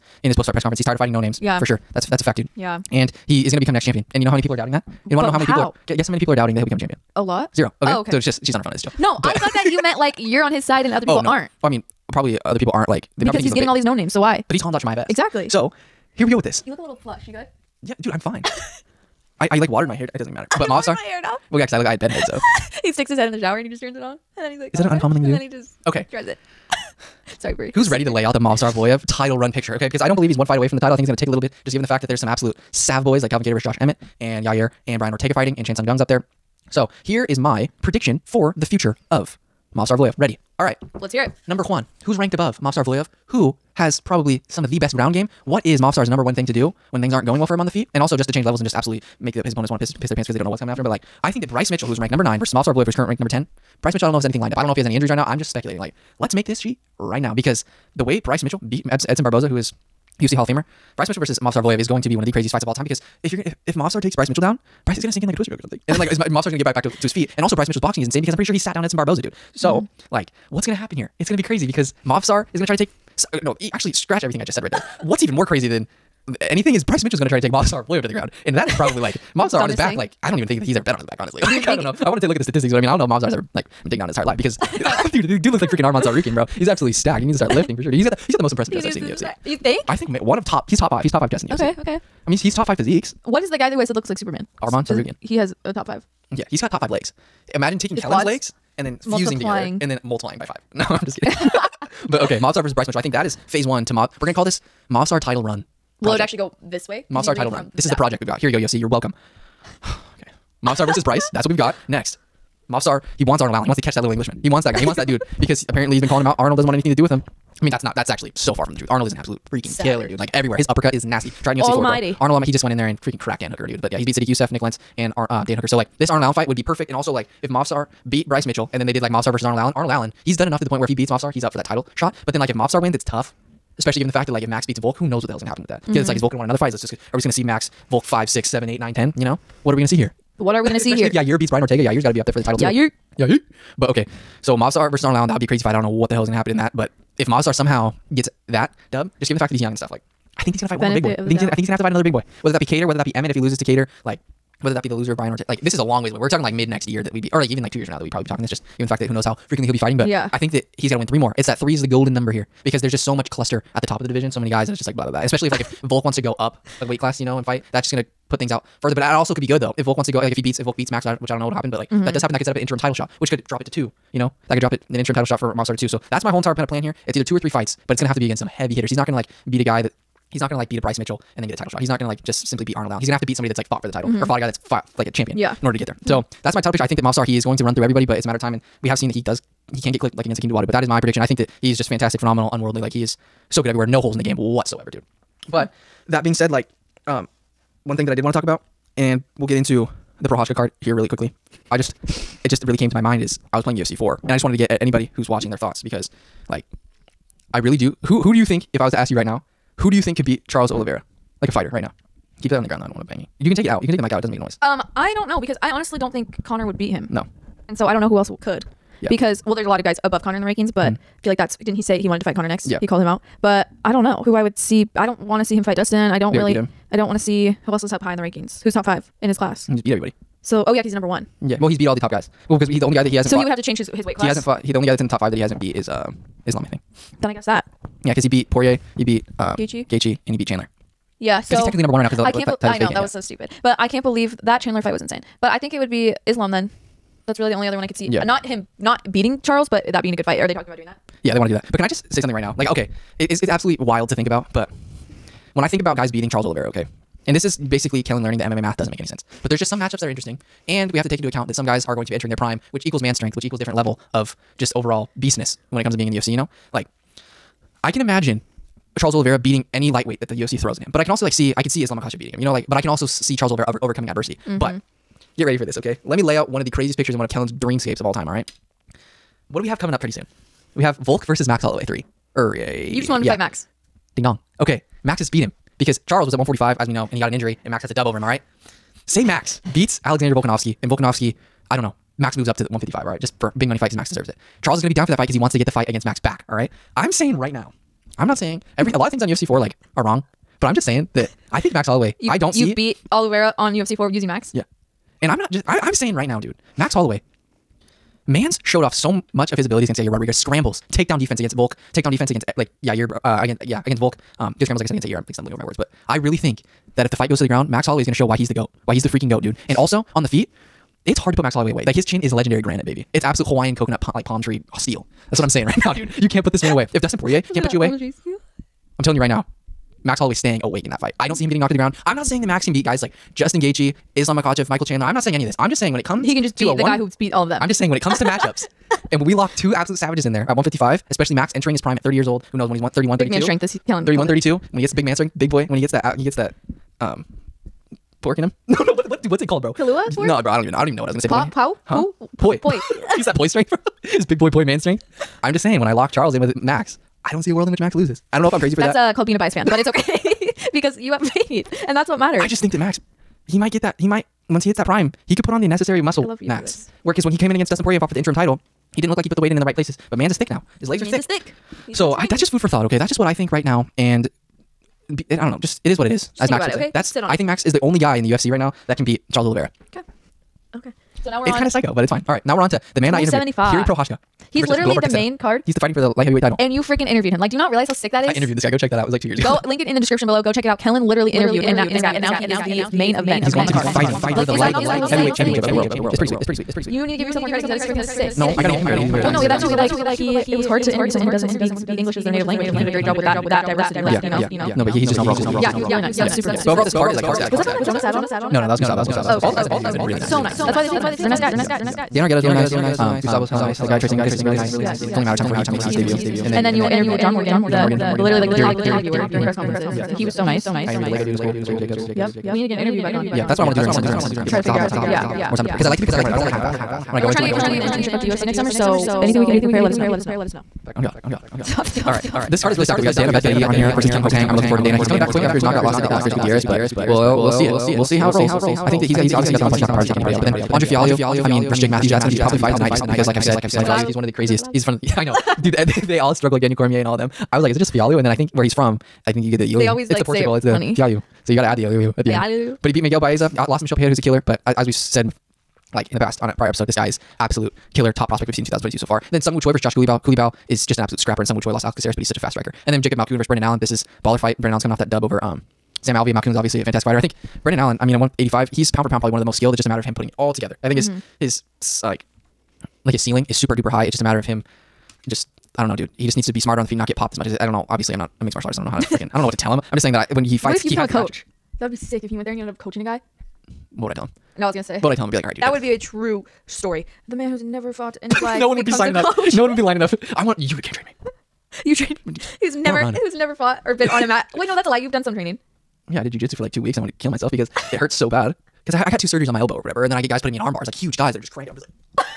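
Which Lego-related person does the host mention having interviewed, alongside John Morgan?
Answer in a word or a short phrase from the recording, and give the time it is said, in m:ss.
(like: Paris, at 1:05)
Jared Jacobs, at 7:01.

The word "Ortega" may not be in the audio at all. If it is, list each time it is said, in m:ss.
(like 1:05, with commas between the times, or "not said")
0:35, 2:21.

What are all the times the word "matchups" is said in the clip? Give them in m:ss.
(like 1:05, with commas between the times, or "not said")
4:19, 5:38.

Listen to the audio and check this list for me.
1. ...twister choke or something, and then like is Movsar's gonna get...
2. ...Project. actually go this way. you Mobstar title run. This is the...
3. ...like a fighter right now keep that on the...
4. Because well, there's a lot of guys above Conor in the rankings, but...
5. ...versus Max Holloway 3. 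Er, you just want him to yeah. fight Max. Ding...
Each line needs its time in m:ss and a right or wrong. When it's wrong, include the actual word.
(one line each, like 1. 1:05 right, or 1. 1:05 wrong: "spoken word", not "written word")
1. 1:05 wrong: "Mobstar", not "Movsar"
2. 1:46 right
3. 3:31 right
4. 3:39 right
5. 4:41 right.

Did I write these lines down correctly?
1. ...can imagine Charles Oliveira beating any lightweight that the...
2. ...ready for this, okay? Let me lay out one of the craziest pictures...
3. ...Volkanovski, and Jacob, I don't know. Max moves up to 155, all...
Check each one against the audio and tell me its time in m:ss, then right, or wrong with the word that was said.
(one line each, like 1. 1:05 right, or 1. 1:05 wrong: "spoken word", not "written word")
1. 4:27 right
2. 4:35 right
3. 4:50 wrong: "Volkanovski", not "Jacob".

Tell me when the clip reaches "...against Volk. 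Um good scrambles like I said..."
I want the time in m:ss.
5:13.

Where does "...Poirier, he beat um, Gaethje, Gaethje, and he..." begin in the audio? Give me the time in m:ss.
3:58.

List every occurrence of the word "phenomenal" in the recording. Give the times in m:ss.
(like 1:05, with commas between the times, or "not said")
3:12.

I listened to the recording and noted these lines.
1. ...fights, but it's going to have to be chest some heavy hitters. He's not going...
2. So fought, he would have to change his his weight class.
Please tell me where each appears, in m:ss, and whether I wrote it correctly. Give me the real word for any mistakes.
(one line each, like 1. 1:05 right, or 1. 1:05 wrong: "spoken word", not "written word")
1. 2:57 wrong: "against", not "chest"
2. 3:53 right.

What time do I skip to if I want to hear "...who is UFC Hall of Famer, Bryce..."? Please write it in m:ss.
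0:59.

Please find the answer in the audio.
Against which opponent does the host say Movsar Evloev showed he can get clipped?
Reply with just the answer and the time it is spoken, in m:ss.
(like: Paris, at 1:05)
Hakeem Dawodu, at 3:10.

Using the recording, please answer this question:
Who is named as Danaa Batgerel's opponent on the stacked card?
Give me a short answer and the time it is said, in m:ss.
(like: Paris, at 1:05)
Kyung Ho Kang, at 7:14.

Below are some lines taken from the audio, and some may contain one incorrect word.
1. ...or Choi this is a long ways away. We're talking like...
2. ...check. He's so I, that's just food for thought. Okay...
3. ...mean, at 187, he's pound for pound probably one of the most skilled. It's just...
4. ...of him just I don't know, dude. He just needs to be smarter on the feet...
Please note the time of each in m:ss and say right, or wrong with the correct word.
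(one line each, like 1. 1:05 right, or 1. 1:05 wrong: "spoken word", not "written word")
1. 2:35 wrong: "Like", not "Choi"
2. 6:11 wrong: "thick", not "check"
3. 7:48 wrong: "185", not "187"
4. 7:54 right.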